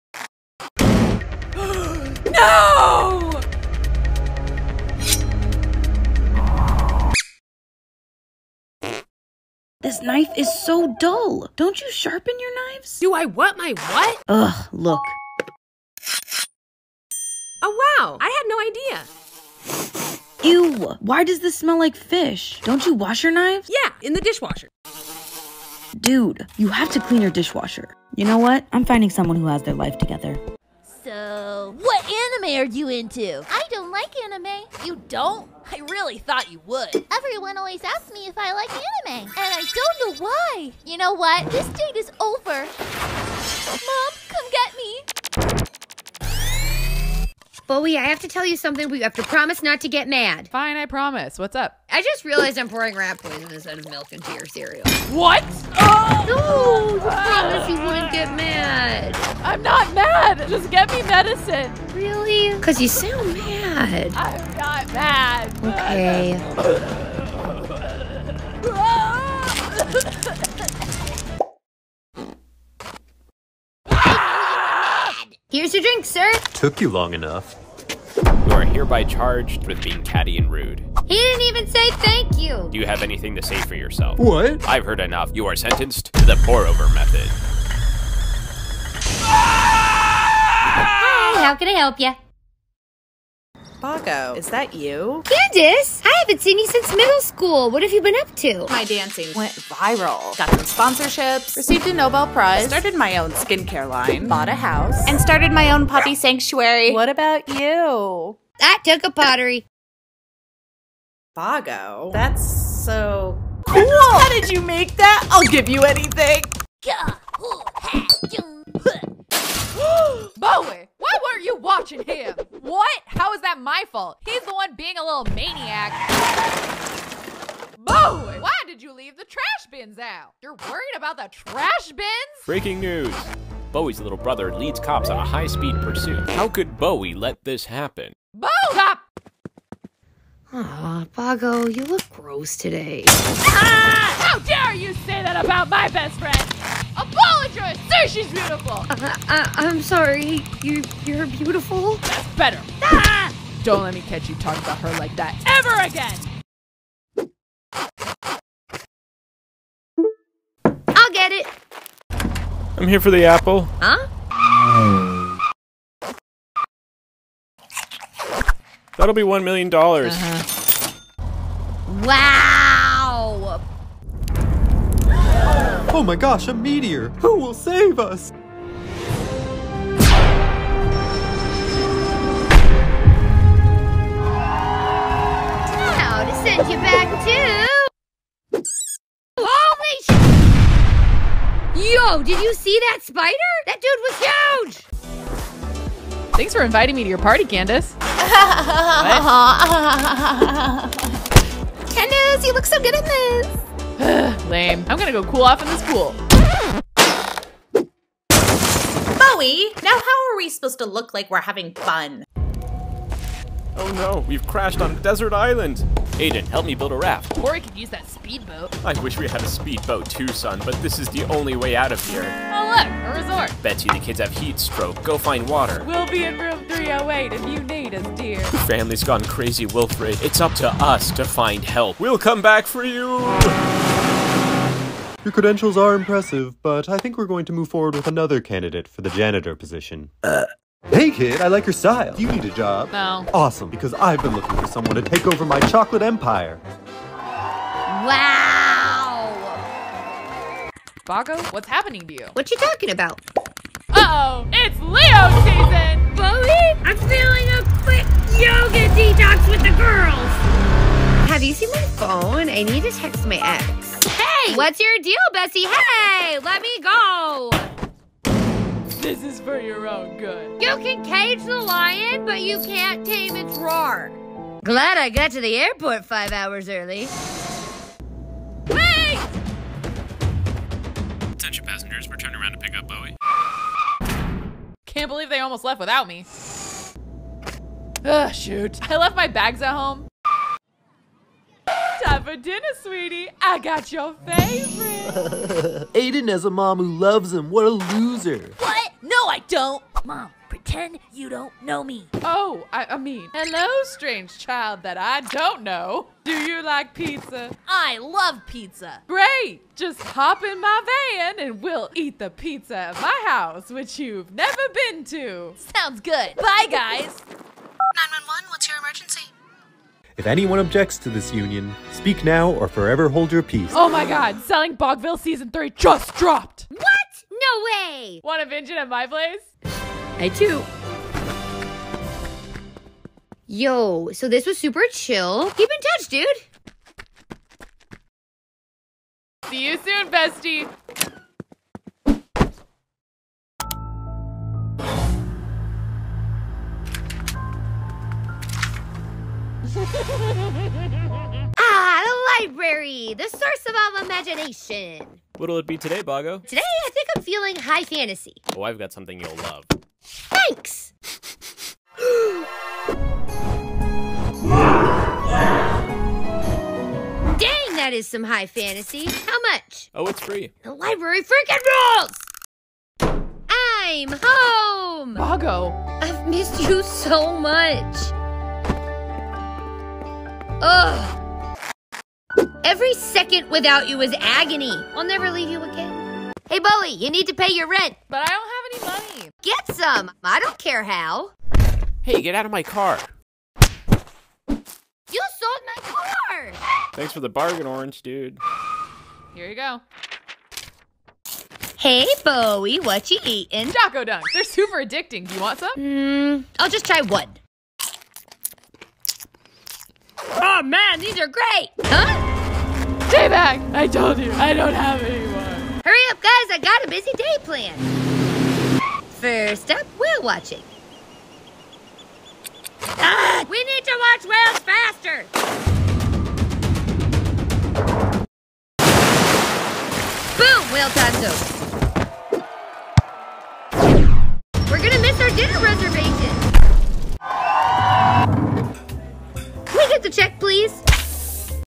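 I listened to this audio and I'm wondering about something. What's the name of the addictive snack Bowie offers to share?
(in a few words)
Choco Dunks.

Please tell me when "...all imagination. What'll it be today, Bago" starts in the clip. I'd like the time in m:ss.
5:53.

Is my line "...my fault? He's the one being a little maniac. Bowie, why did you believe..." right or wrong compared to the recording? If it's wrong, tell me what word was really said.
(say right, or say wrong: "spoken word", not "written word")
wrong: "leave", not "believe".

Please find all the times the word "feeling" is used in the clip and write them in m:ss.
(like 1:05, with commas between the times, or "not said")
4:16, 5:57.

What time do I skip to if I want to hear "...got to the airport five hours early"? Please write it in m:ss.
4:35.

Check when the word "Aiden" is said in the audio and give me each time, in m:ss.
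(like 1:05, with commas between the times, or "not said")
3:36, 4:55.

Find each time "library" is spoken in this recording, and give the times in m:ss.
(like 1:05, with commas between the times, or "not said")
5:52, 6:10.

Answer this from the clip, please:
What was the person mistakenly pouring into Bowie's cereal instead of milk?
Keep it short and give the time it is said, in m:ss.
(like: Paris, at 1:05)
Rat poison, at 0:52.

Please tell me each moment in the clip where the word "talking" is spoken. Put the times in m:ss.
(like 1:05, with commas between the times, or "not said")
2:34, 4:12.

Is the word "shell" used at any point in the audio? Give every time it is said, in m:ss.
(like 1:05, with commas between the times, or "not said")
not said.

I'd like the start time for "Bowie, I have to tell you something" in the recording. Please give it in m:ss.
0:47.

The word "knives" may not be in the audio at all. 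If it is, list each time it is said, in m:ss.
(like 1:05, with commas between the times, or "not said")
0:12, 0:23.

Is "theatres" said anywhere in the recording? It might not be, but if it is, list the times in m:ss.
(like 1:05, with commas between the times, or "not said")
not said.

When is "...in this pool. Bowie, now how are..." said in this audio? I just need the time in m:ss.
3:25.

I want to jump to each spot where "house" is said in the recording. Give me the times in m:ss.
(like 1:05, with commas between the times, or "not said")
1:44, 5:13.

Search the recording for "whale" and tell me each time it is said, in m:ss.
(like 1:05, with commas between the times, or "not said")
6:59, 7:04, 7:10.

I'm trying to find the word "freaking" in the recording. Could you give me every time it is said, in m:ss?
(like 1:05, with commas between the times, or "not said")
6:11.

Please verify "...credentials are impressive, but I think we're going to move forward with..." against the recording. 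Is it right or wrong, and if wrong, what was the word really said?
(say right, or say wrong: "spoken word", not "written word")
right.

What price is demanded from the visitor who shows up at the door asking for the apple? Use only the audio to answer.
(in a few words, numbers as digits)
1 million dollars.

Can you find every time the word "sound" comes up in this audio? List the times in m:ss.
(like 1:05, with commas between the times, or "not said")
1:02, 5:15.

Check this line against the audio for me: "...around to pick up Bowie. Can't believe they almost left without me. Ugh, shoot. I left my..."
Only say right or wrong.
right.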